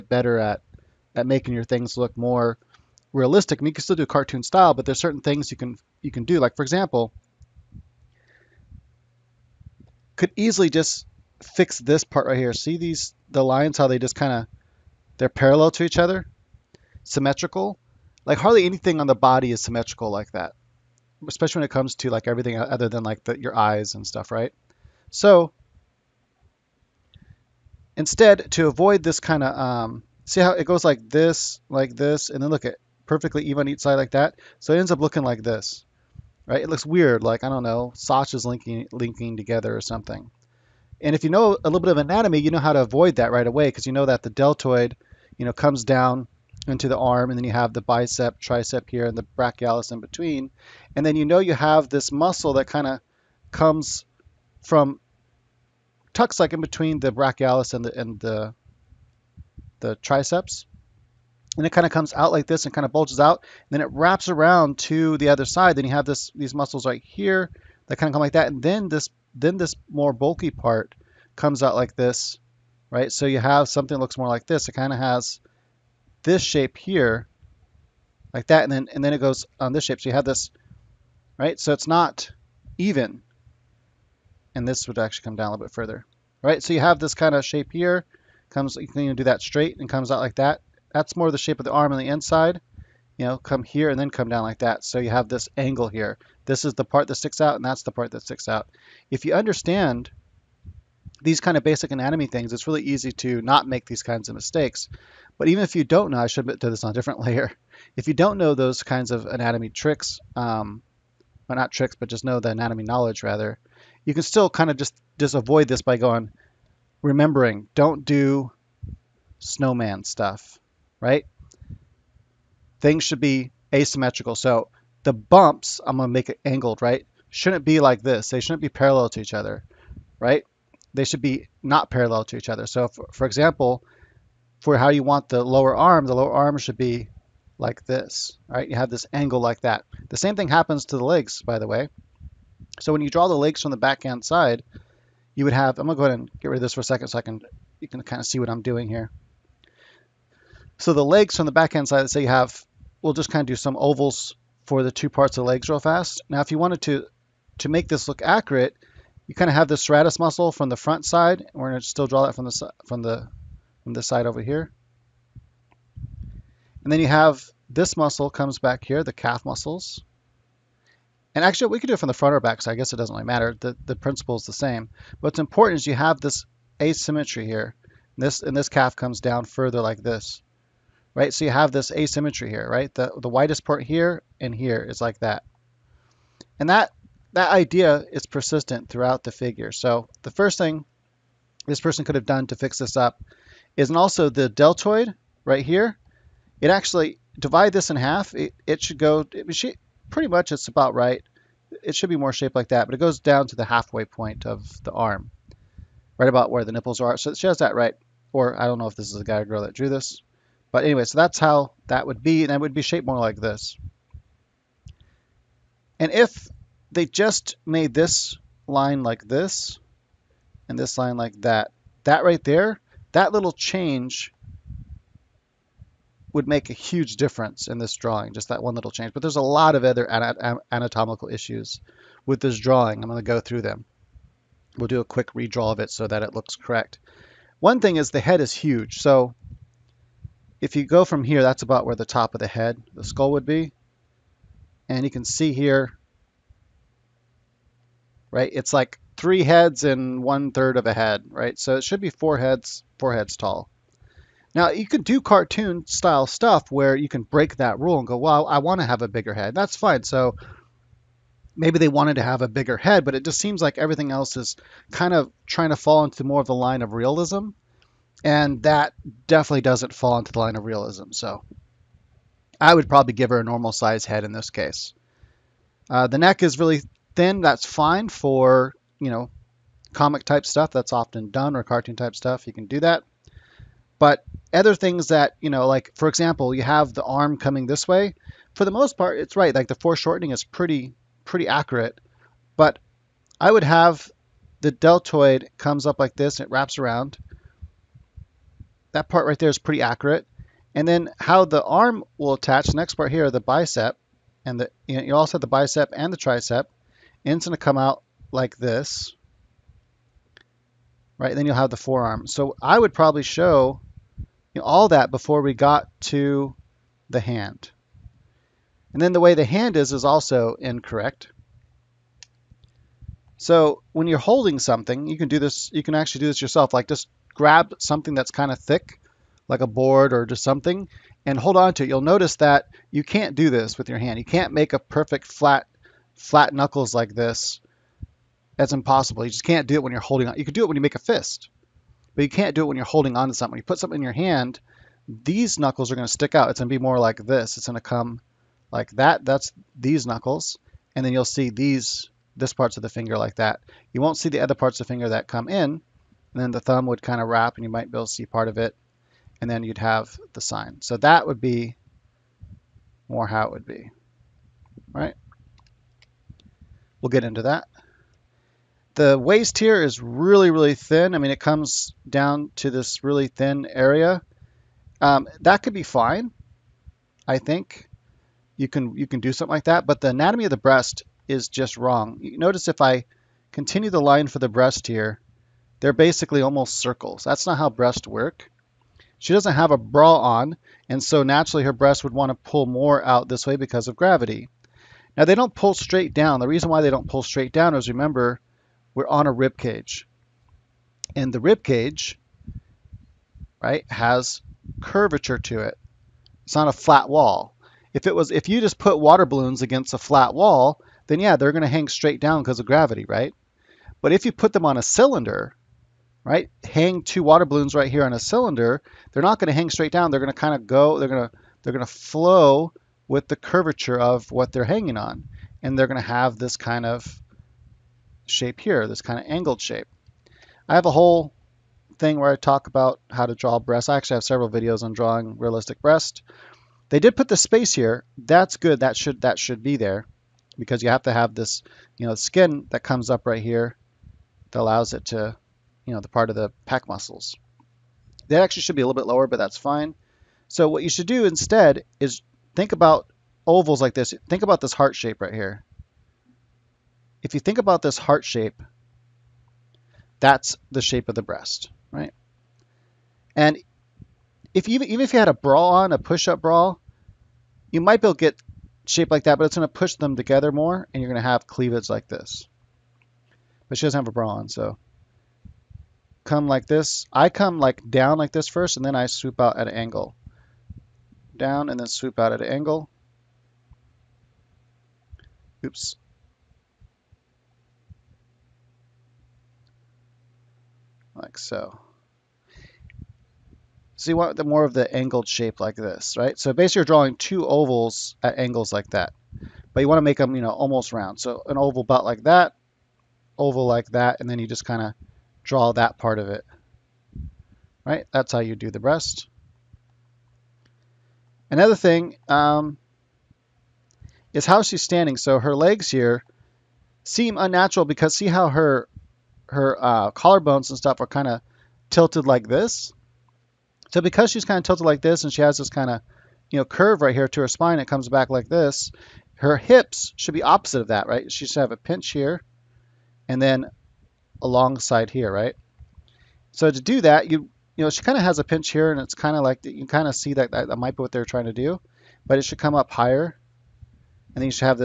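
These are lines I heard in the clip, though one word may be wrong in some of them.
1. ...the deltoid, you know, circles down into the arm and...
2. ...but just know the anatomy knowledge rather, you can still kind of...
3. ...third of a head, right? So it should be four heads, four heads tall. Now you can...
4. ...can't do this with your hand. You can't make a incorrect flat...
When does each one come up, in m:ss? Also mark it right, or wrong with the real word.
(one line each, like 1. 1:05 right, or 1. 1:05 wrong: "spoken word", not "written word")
1. 0:44 wrong: "comes", not "circles"
2. 1:51 right
3. 4:10 right
4. 5:33 wrong: "perfect", not "incorrect".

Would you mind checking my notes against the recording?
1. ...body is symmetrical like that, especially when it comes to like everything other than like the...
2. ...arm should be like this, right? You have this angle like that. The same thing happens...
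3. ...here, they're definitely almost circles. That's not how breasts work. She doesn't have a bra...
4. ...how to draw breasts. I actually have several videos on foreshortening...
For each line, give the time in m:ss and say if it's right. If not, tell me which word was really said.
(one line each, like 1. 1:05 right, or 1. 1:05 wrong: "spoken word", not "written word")
1. 0:19 right
2. 2:16 right
3. 6:24 wrong: "basically", not "definitely"
4. 7:13 wrong: "drawing", not "foreshortening".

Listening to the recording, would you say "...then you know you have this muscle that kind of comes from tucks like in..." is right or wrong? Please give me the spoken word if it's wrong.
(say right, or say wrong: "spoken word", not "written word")
right.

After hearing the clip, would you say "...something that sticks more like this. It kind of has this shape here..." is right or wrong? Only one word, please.
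wrong.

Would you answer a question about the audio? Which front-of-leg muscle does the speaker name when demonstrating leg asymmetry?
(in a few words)
Sartorius.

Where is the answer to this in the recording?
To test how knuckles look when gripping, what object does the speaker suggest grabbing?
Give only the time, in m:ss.
5:29.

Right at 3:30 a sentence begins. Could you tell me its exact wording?
But anyway, so that's how that would be, and it would be shaped more like this.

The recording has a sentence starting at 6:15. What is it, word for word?
Um, that could be fine, I think.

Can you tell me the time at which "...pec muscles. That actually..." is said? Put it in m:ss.
7:26.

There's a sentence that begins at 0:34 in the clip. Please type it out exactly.
So it ends up looking like this, right?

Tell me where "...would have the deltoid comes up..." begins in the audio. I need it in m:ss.
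4:53.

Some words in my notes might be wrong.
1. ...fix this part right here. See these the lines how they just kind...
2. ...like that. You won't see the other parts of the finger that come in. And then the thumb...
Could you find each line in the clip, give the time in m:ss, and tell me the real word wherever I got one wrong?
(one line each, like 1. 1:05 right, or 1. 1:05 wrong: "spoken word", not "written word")
1. 0:11 right
2. 5:53 right.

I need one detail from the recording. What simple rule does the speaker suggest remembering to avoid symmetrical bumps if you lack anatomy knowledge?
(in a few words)
Don't do snowman stuff.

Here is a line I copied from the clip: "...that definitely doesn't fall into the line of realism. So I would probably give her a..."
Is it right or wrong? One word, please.
right.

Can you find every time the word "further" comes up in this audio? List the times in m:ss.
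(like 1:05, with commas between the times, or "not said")
1:25, 2:59.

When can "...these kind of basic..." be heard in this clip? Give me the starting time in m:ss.
1:41.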